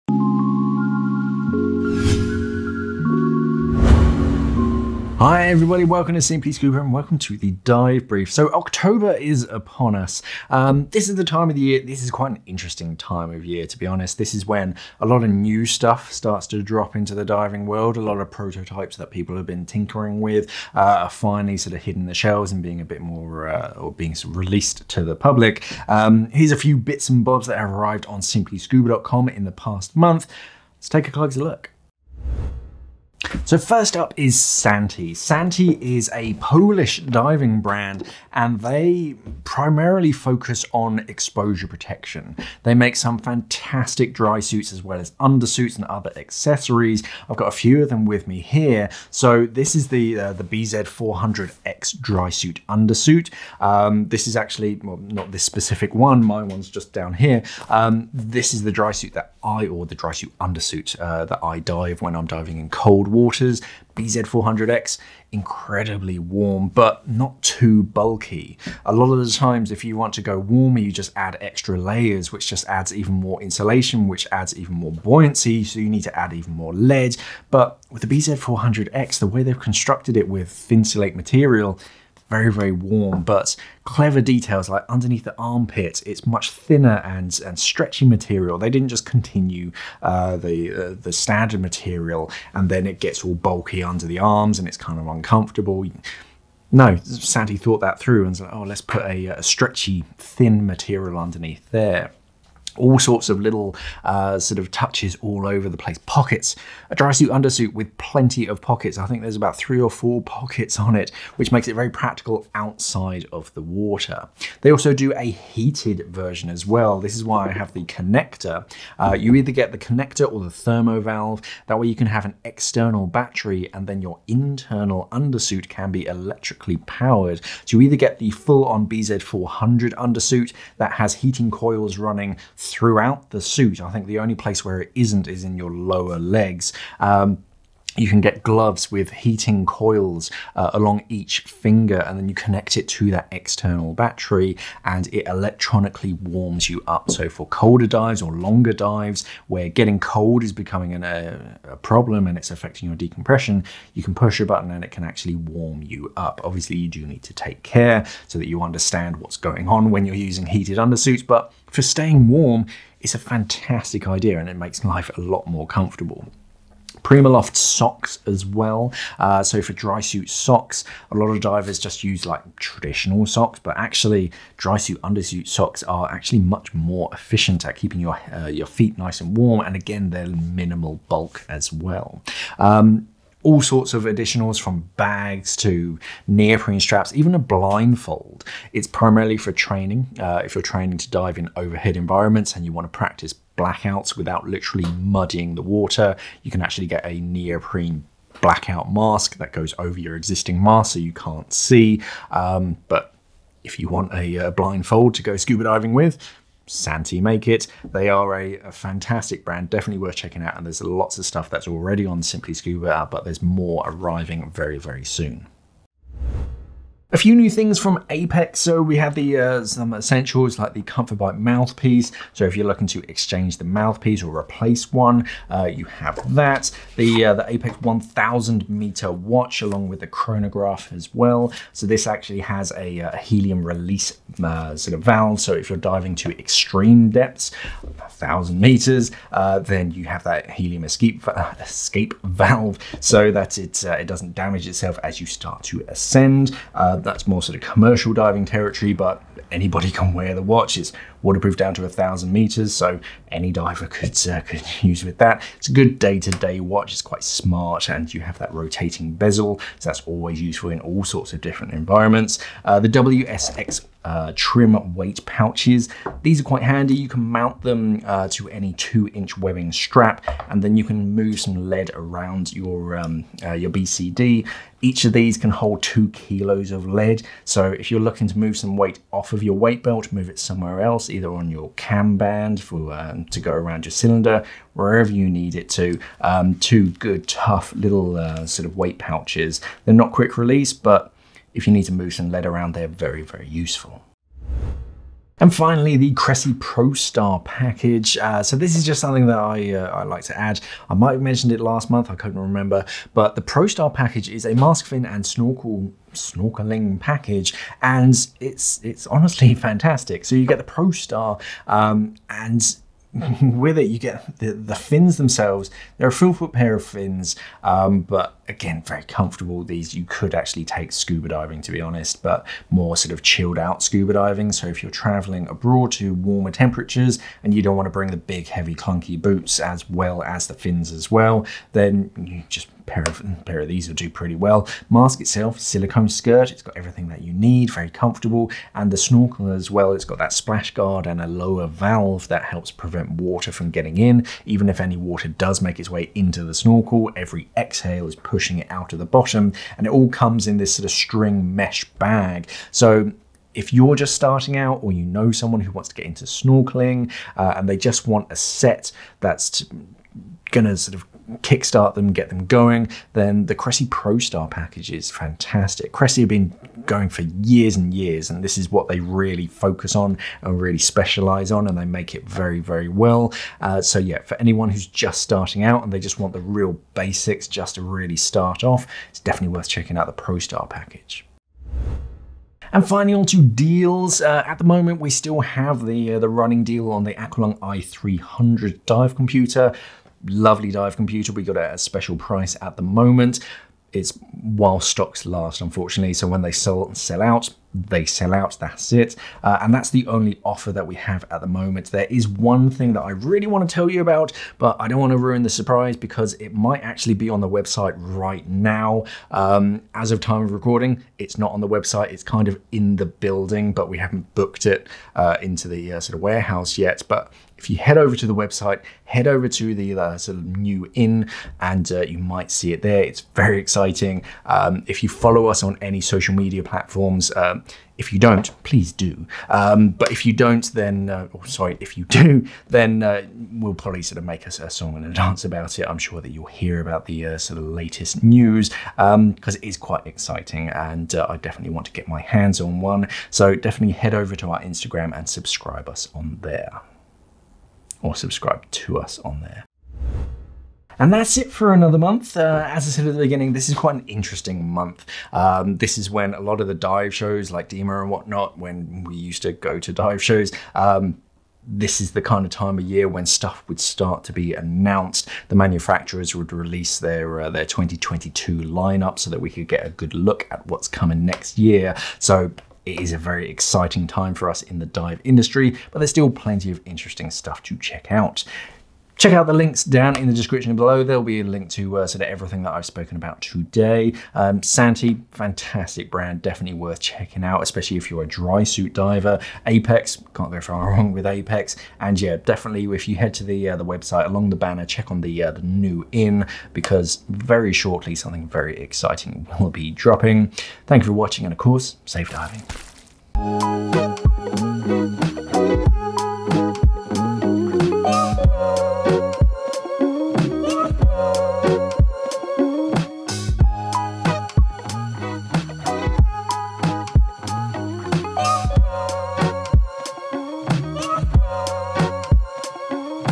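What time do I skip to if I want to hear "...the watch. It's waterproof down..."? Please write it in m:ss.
4:10.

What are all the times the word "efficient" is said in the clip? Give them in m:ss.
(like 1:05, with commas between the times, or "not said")
2:57.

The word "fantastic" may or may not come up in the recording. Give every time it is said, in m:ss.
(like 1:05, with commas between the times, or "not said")
0:43, 2:43, 3:28, 5:09, 6:05, 8:05.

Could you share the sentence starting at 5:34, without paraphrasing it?
Mask itself, silicone skirt, it's got everything that you need, very comfortable, and the snorkel as well.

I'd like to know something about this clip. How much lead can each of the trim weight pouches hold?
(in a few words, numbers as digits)
2 kilos.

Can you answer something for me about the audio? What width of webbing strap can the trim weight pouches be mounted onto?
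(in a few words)
2 inch.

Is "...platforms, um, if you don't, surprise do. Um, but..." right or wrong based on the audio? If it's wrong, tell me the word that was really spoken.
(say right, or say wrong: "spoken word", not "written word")
wrong: "please", not "surprise".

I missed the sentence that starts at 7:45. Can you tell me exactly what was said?
The manufacturers would release their uh, their 2022 lineup so that we could get a good look at what's coming next year.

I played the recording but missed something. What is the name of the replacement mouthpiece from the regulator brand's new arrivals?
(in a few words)
Comfortbite.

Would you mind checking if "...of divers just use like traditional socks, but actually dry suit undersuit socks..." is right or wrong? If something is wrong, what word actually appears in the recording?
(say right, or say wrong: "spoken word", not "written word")
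right.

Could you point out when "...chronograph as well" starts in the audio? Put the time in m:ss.
3:50.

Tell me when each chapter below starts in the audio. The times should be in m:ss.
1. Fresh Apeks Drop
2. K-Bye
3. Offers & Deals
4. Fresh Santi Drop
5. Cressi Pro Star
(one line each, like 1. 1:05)
1. 3:36
2. 7:30
3. 6:21
4. 0:32
5. 4:54.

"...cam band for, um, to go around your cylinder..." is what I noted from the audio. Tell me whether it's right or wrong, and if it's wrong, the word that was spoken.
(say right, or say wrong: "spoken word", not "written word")
right.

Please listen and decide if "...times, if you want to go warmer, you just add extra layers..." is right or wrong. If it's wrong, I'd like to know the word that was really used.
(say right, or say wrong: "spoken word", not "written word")
right.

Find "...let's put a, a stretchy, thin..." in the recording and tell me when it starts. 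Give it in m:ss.
1:38.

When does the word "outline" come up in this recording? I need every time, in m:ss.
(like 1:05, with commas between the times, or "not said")
not said.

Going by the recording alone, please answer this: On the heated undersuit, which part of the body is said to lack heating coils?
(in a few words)
lower legs.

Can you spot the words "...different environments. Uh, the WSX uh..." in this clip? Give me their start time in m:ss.
4:21.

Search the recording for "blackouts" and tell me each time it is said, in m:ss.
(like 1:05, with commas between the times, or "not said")
3:13, 3:18.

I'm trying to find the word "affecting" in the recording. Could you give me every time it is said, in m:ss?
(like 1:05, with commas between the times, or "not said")
2:32.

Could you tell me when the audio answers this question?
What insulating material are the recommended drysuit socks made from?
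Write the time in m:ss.
2:47.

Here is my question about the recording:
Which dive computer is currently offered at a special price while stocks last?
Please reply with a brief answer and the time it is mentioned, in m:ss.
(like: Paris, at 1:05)
Aqualung i300, at 6:27.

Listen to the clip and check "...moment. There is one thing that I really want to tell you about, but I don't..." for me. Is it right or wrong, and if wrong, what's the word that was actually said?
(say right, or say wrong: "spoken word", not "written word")
right.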